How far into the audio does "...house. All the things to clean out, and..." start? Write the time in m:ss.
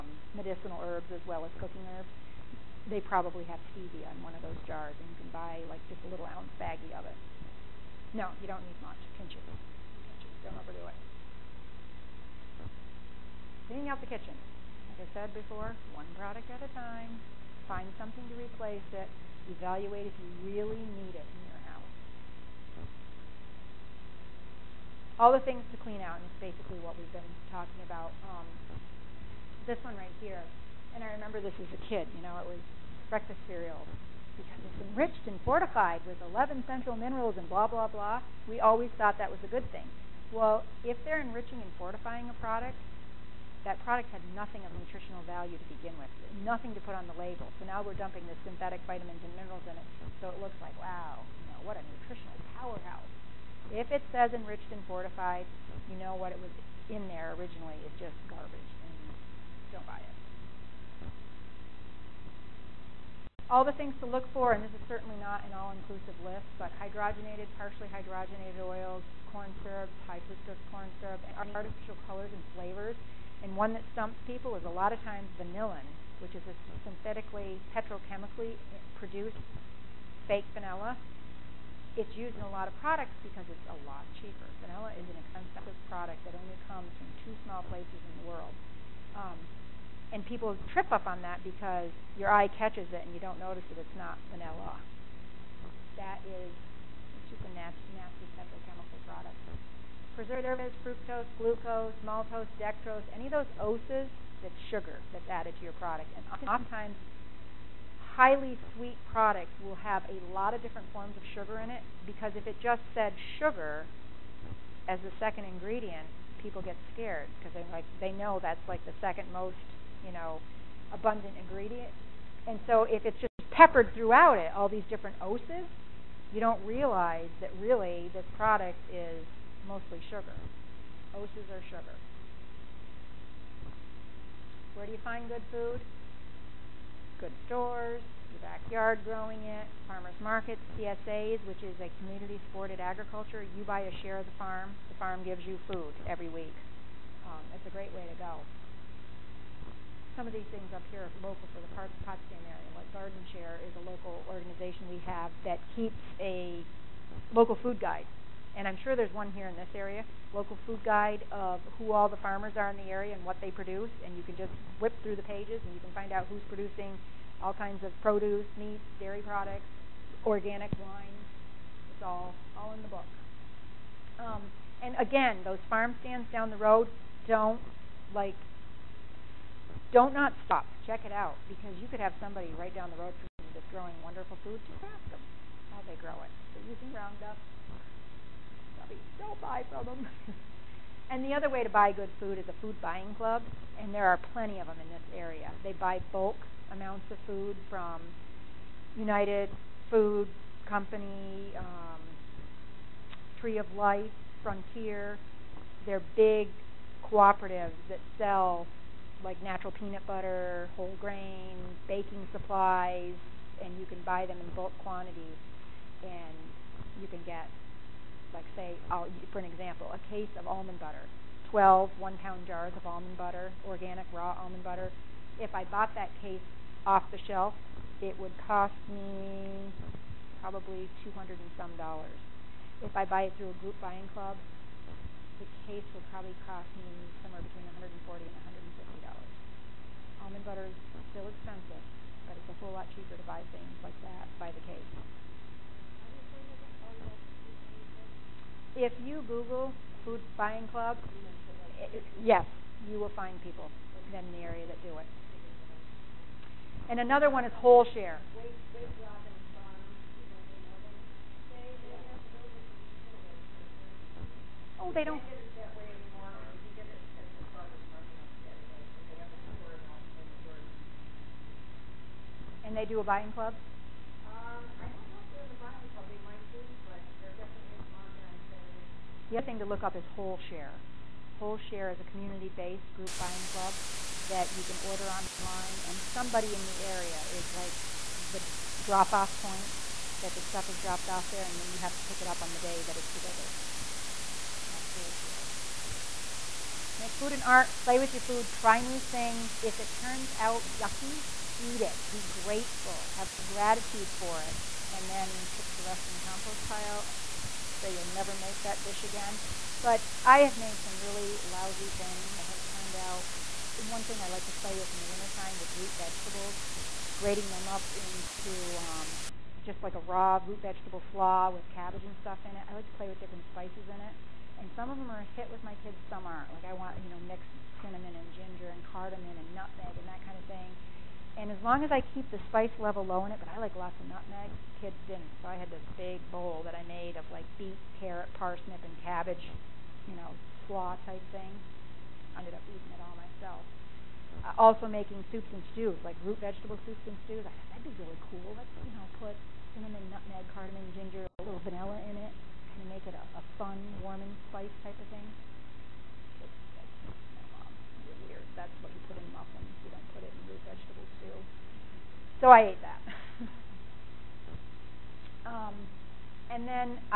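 0:21.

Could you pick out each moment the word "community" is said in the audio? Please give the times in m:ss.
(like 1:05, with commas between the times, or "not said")
2:21, 4:42.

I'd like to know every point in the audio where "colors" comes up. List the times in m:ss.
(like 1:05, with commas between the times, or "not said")
1:12.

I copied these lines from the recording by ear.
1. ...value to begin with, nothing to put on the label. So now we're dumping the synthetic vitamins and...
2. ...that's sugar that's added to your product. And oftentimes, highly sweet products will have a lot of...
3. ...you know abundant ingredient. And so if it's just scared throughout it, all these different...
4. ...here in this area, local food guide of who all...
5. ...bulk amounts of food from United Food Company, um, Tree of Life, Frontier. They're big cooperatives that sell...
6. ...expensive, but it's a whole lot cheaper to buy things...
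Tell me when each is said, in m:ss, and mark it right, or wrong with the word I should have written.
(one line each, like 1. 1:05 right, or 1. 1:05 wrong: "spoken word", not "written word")
1. 0:45 right
2. 1:44 right
3. 2:00 wrong: "peppered", not "scared"
4. 2:39 right
5. 3:16 right
6. 4:01 right.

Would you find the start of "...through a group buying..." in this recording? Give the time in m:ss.
3:53.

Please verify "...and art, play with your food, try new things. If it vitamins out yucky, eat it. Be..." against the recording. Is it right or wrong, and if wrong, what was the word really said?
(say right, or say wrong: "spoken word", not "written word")
wrong: "turns", not "vitamins".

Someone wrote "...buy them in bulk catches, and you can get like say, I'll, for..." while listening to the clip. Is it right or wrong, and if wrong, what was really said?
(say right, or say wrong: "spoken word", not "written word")
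wrong: "quantities", not "catches".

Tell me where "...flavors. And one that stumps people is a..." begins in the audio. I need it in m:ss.
1:12.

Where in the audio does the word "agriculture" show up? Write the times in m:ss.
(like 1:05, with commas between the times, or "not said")
2:22.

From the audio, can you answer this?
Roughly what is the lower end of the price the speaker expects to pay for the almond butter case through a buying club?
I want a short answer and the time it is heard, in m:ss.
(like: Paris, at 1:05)
$140, at 3:57.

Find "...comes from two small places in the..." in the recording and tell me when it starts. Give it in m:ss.
1:26.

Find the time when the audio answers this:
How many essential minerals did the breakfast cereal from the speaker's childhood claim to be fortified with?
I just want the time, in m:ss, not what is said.
0:36.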